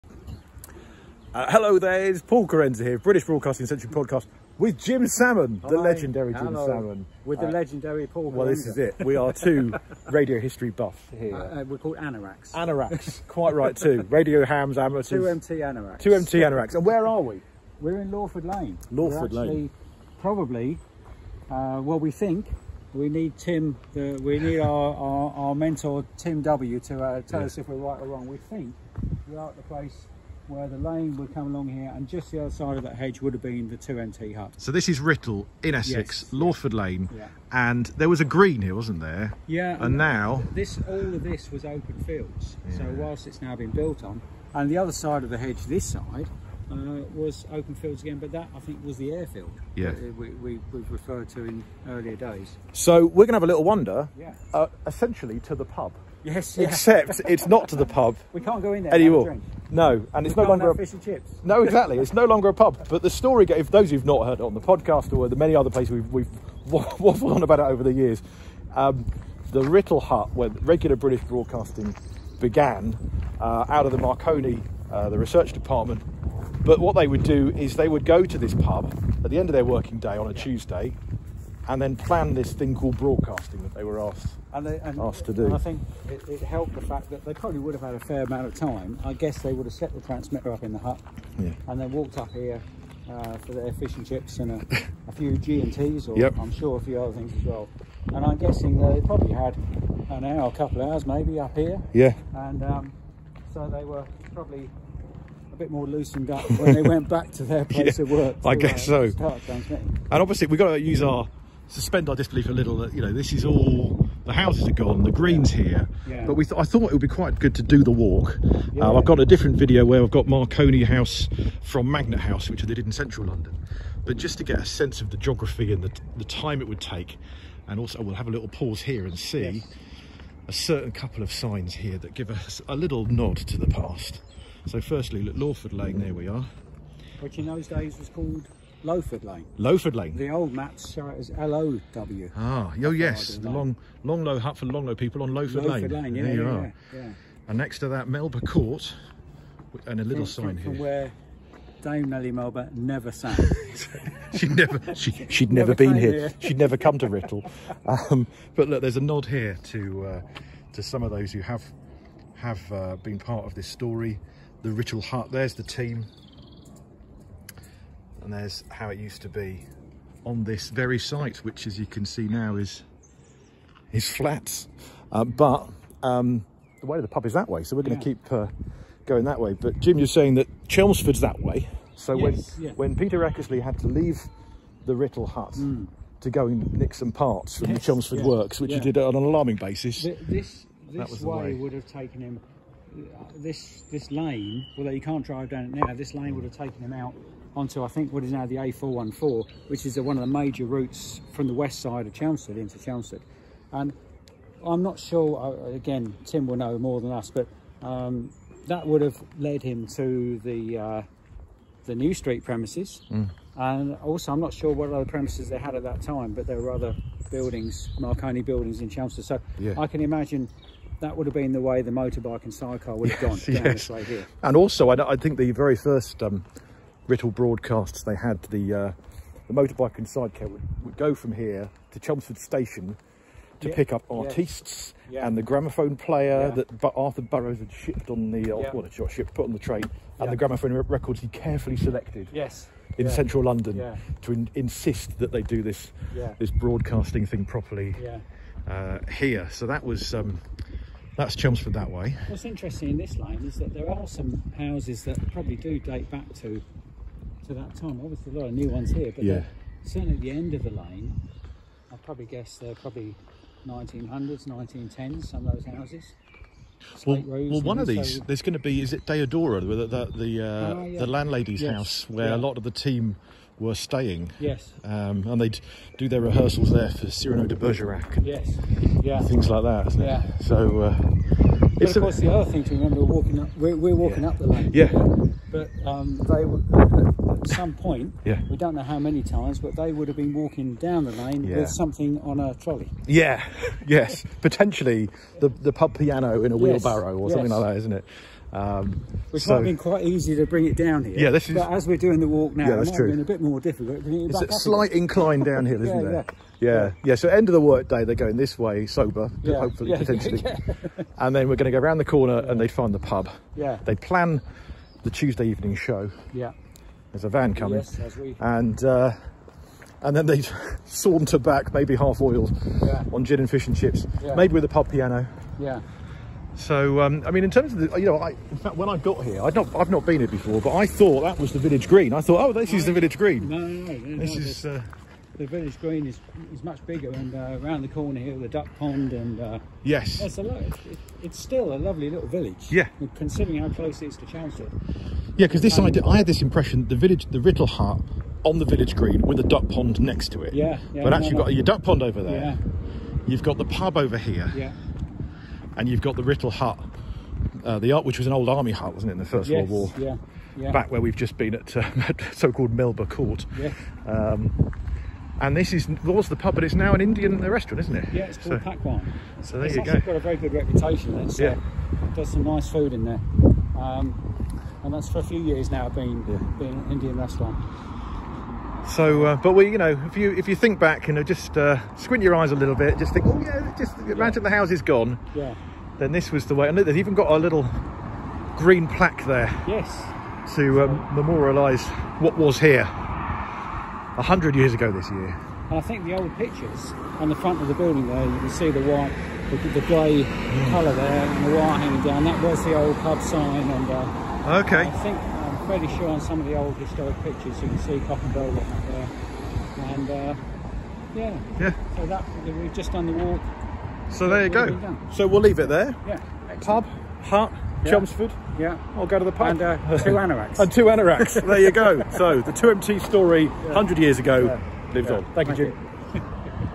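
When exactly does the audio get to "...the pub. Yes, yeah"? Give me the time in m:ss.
0:55.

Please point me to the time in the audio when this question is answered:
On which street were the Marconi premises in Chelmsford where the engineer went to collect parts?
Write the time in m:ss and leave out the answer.
3:31.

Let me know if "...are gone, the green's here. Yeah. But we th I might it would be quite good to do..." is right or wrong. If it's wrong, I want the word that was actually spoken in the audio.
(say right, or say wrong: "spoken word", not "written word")
wrong: "thought", not "might".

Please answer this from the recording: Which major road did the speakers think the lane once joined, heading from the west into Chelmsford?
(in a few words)
A414.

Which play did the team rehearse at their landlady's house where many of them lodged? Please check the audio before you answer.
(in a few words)
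Cyrano de Bergerac.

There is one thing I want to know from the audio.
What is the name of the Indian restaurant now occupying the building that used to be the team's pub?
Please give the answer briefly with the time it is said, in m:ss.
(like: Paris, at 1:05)
Pakwaan, at 6:08.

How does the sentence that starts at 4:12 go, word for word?
What's interesting in this line is that there are some houses that probably do date back to to that time.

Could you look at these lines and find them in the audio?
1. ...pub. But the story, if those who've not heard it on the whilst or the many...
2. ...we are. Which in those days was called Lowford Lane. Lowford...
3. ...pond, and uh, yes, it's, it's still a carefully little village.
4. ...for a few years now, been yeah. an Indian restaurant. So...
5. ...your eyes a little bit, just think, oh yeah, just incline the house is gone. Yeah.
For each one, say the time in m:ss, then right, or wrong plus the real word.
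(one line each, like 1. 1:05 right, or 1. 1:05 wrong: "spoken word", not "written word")
1. 1:02 wrong: "podcast", not "whilst"
2. 2:16 right
3. 5:38 wrong: "lovely", not "carefully"
4. 6:15 right
5. 6:22 wrong: "imagine", not "incline".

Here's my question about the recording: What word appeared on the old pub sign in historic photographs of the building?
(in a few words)
Cock.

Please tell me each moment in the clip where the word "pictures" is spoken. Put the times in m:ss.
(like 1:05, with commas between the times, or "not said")
6:36, 6:47.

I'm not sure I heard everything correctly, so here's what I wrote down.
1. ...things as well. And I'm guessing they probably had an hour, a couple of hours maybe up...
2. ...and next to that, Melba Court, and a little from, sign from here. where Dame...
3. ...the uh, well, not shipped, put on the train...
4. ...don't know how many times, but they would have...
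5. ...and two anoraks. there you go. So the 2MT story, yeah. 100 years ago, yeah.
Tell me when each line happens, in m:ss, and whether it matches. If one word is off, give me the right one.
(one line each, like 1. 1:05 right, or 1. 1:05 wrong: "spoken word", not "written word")
1. 1:37 right
2. 2:27 right
3. 3:58 right
4. 4:48 right
5. 7:00 right.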